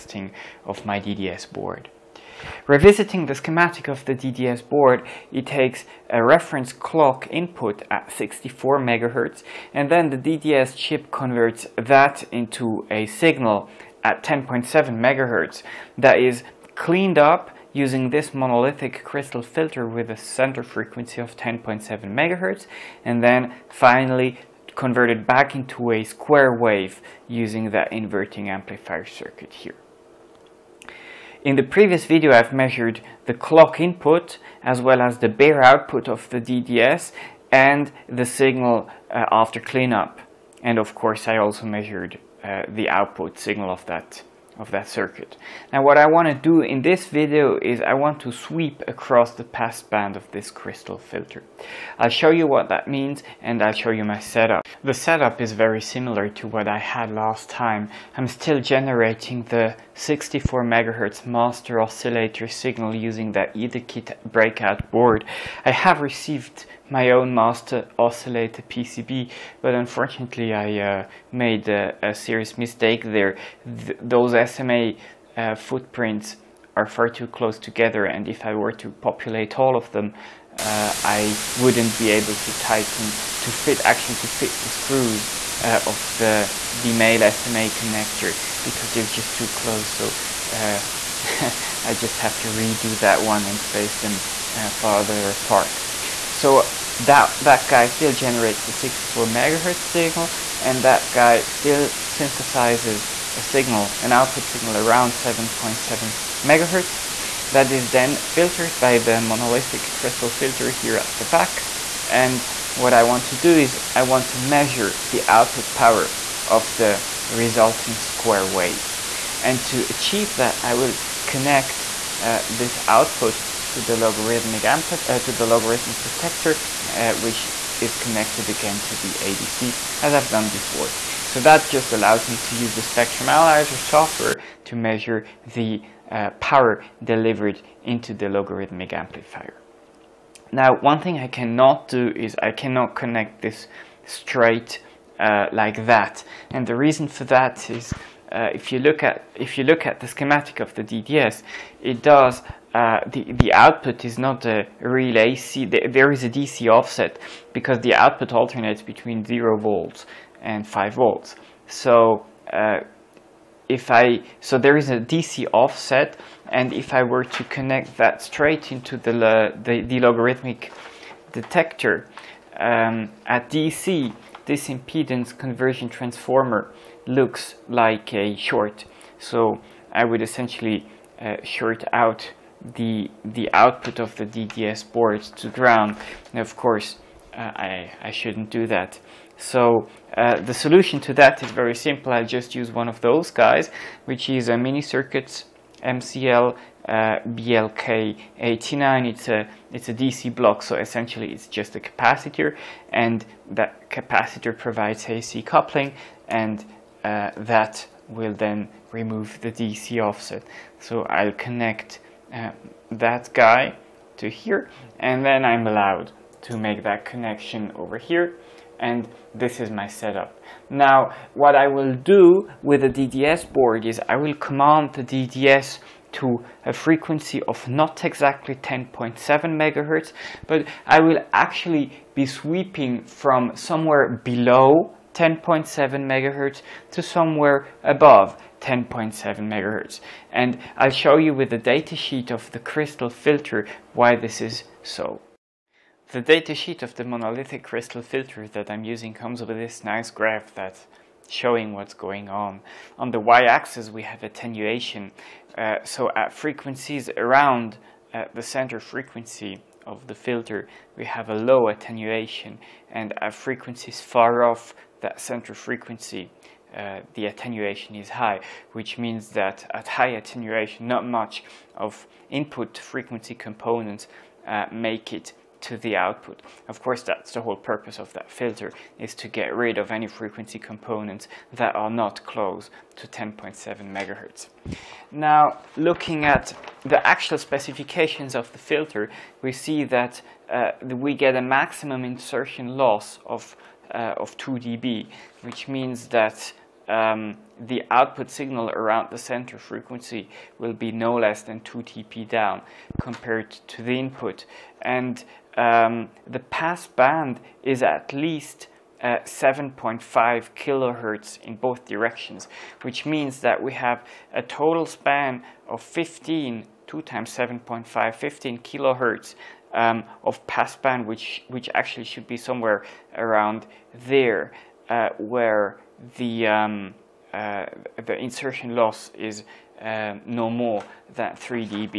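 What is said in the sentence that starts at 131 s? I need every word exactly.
So that just allows me to use the spectrum analyzer software to measure the uh, power delivered into the logarithmic amplifier.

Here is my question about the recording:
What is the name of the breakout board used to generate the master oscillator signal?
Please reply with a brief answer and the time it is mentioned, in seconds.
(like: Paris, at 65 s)
Etherkit, at 63 s.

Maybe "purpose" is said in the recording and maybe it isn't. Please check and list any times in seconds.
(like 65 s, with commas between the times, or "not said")
277 s.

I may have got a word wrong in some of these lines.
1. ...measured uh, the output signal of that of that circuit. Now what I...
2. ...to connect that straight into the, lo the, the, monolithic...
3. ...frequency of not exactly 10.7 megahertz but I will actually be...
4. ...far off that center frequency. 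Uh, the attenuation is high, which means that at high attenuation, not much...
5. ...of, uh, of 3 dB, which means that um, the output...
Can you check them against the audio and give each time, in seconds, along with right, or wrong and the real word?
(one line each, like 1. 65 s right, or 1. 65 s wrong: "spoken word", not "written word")
1. 41 s right
2. 167 s wrong: "logarithmic", not "monolithic"
3. 226 s right
4. 264 s right
5. 293 s wrong: "2", not "3".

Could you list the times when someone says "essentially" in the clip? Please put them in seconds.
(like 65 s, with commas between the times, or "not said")
180 s, 200 s.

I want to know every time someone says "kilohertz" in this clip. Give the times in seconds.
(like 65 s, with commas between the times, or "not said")
310 s, 318 s.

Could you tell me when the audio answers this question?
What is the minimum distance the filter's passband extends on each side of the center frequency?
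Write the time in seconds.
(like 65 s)
309 s.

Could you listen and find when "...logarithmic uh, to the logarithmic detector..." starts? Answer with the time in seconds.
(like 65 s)
123 s.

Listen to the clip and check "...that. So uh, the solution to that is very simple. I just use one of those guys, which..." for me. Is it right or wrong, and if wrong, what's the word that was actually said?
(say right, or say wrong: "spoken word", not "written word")
right.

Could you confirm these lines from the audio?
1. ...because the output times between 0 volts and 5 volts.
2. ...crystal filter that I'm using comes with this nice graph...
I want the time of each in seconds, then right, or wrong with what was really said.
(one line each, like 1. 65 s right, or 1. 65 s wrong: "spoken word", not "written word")
1. 157 s wrong: "alternates", not "times"
2. 247 s right.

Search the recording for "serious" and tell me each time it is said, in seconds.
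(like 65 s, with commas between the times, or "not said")
72 s.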